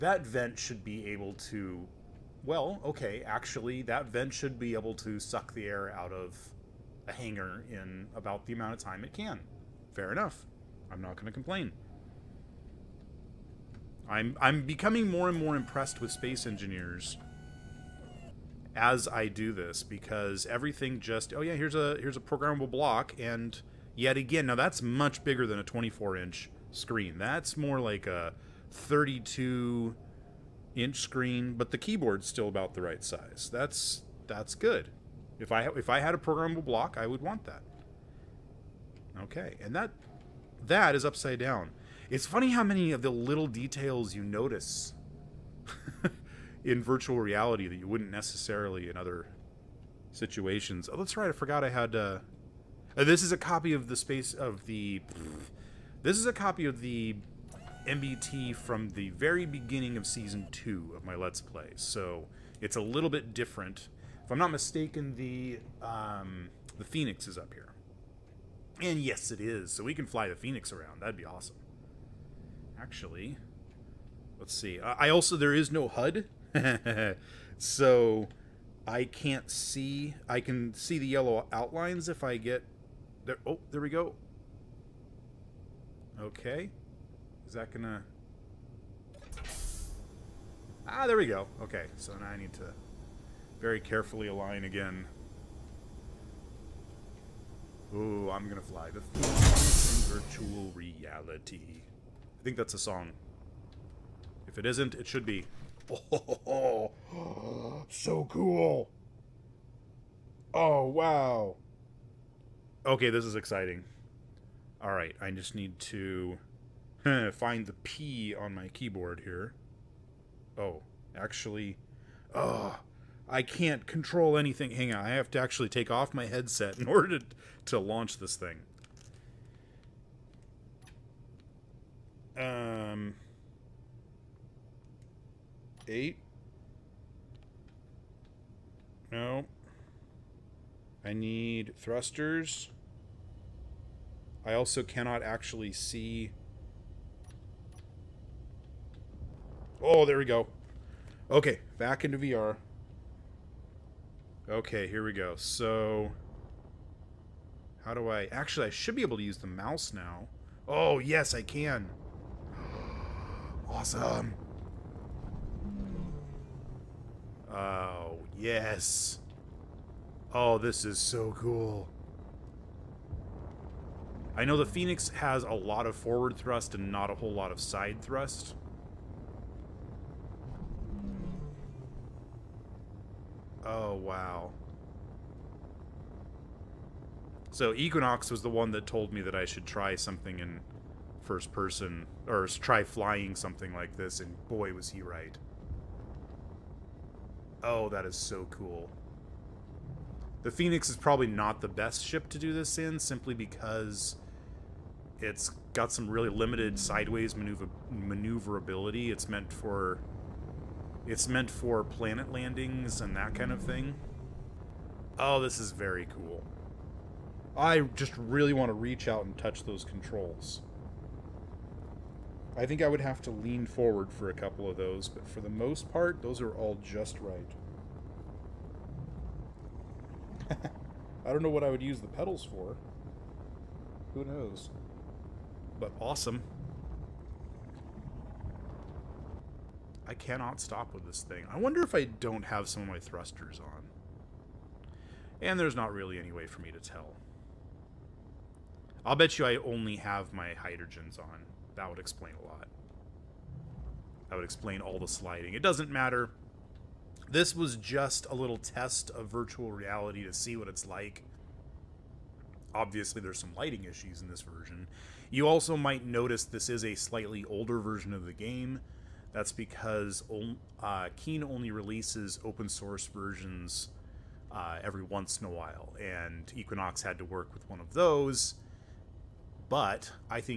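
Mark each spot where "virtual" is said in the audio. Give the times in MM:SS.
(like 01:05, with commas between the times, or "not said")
00:46, 01:40, 04:19.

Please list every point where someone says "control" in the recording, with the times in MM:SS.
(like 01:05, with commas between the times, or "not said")
02:03, 03:39.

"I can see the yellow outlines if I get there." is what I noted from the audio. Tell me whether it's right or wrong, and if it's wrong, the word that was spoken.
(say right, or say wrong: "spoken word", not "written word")
right.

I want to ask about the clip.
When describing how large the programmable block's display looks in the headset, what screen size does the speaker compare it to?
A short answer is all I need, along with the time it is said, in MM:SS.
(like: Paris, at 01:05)
32 inch, at 00:28.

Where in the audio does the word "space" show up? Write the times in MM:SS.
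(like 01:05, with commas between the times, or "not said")
00:16, 00:53.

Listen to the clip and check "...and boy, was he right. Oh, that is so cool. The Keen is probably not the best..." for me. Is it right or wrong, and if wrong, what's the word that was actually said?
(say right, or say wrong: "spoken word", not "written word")
wrong: "Phoenix", not "Keen".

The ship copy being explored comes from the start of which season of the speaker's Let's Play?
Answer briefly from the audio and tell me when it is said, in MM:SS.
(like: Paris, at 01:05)
Season 2, at 01:00.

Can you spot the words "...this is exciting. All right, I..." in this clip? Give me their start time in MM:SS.
01:53.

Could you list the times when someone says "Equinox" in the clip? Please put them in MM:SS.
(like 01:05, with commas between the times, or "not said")
03:07, 04:36.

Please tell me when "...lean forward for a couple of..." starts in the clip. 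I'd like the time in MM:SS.
03:43.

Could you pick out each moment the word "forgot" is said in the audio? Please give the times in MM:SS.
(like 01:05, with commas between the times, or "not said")
00:51.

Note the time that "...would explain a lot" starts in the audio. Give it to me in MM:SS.
04:11.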